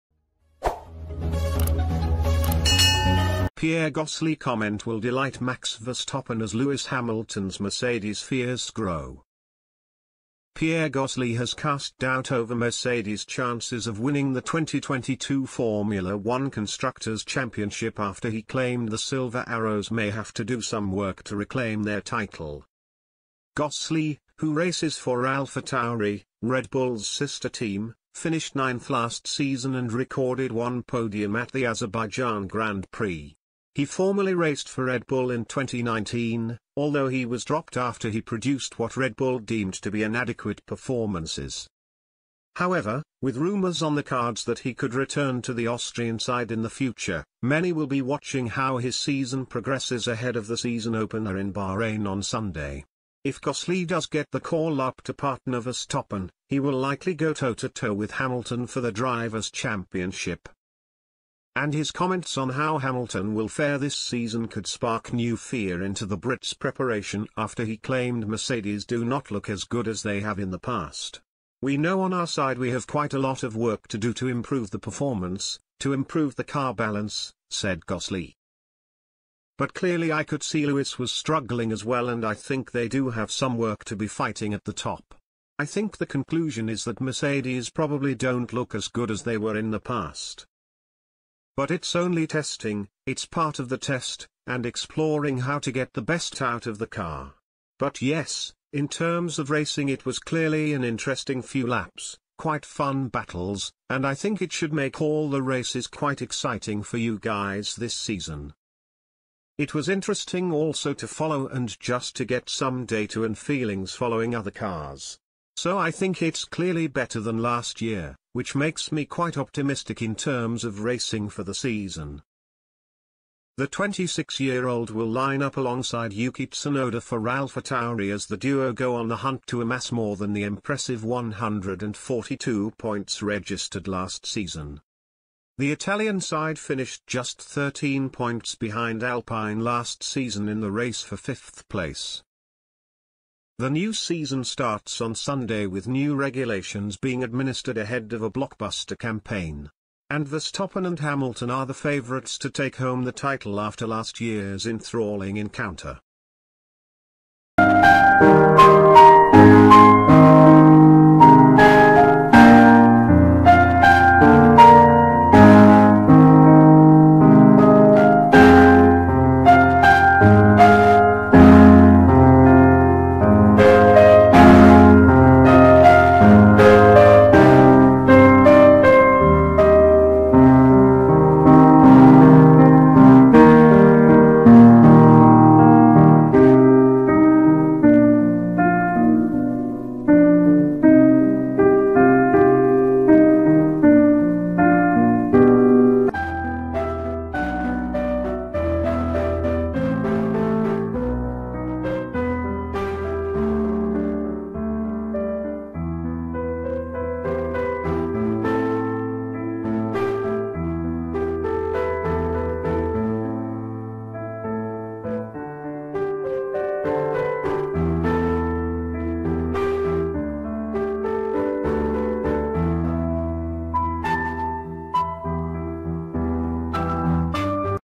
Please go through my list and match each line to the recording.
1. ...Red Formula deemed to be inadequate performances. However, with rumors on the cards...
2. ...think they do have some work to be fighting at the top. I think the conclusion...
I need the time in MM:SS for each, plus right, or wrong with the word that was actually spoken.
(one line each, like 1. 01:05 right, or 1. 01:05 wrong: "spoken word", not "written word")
1. 00:38 wrong: "Bull", not "Formula"
2. 01:22 right.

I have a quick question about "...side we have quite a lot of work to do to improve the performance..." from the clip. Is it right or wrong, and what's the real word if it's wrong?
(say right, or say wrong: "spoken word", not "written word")
right.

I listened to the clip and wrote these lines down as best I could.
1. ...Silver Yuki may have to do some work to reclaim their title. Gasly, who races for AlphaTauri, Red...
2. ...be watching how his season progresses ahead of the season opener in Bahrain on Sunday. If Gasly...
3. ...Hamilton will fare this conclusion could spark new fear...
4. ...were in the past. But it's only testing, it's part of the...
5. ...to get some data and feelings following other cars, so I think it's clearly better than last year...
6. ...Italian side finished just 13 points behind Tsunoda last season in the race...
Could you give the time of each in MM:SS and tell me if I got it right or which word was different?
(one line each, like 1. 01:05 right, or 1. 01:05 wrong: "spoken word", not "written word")
1. 00:18 wrong: "Arrows", not "Yuki"
2. 00:47 right
3. 01:02 wrong: "season", not "conclusion"
4. 01:29 right
5. 01:52 right
6. 02:15 wrong: "Alpine", not "Tsunoda".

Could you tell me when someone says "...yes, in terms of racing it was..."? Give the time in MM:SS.
01:38.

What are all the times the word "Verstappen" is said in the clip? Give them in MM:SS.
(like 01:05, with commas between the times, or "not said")
00:05, 00:55, 02:30.